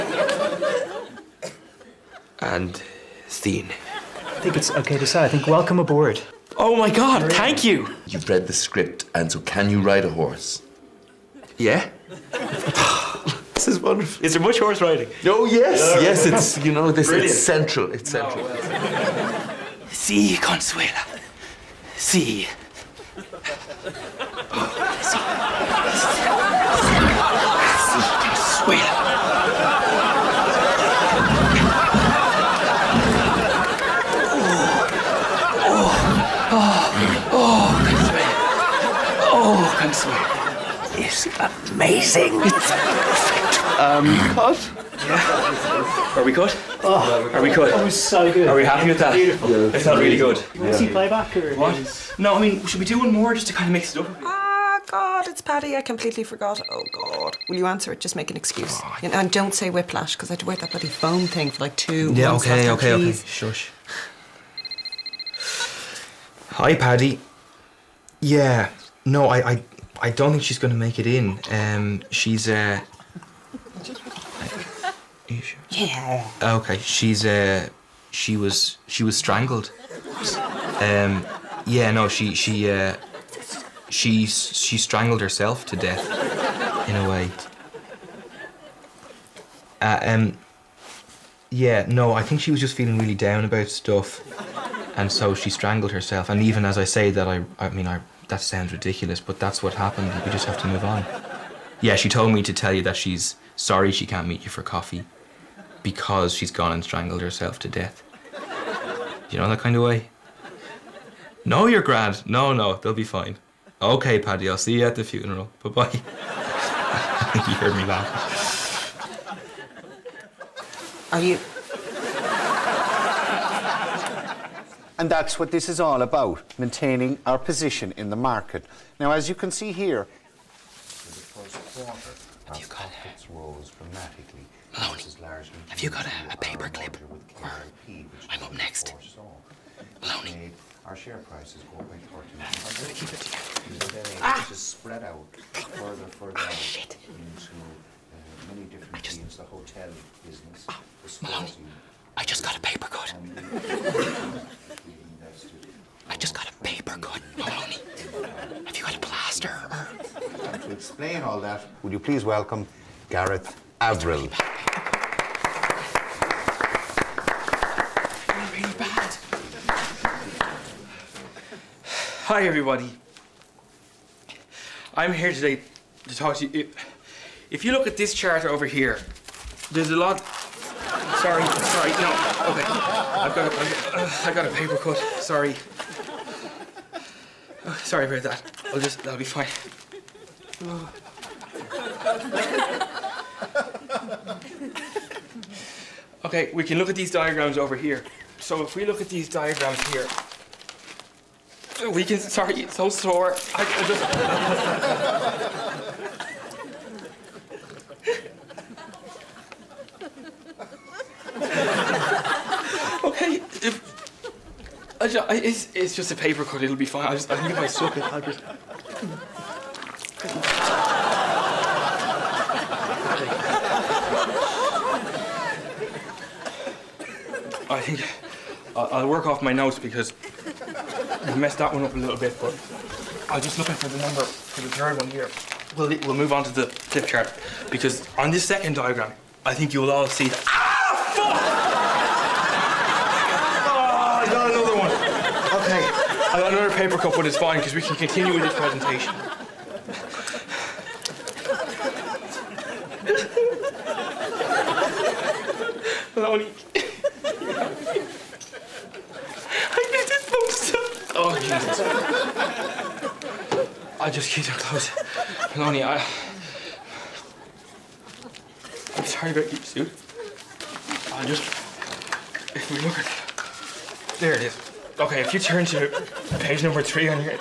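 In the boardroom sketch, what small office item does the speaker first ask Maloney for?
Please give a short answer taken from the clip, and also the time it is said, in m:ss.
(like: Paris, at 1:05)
a paper clip, at 2:16.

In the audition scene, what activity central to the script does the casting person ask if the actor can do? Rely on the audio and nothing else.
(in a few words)
ride a horse.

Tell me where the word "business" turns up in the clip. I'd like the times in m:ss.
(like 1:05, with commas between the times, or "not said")
2:30.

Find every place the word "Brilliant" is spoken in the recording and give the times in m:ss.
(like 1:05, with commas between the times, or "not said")
0:17.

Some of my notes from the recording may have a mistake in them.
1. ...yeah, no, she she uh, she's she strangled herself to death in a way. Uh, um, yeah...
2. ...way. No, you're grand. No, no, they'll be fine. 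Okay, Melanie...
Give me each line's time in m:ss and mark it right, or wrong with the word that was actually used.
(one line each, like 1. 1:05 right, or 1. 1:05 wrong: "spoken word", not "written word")
1. 1:21 right
2. 1:49 wrong: "Paddy", not "Melanie".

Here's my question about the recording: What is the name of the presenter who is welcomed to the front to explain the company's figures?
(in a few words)
Gareth Avril.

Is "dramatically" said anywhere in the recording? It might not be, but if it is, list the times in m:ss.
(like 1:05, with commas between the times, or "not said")
2:13.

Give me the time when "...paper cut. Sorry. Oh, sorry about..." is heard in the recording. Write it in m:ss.
3:04.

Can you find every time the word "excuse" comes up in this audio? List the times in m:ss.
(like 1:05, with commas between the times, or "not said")
0:58.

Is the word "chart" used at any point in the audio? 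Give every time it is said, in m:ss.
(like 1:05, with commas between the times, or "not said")
2:58, 3:57.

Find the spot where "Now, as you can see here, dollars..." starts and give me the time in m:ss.
2:08.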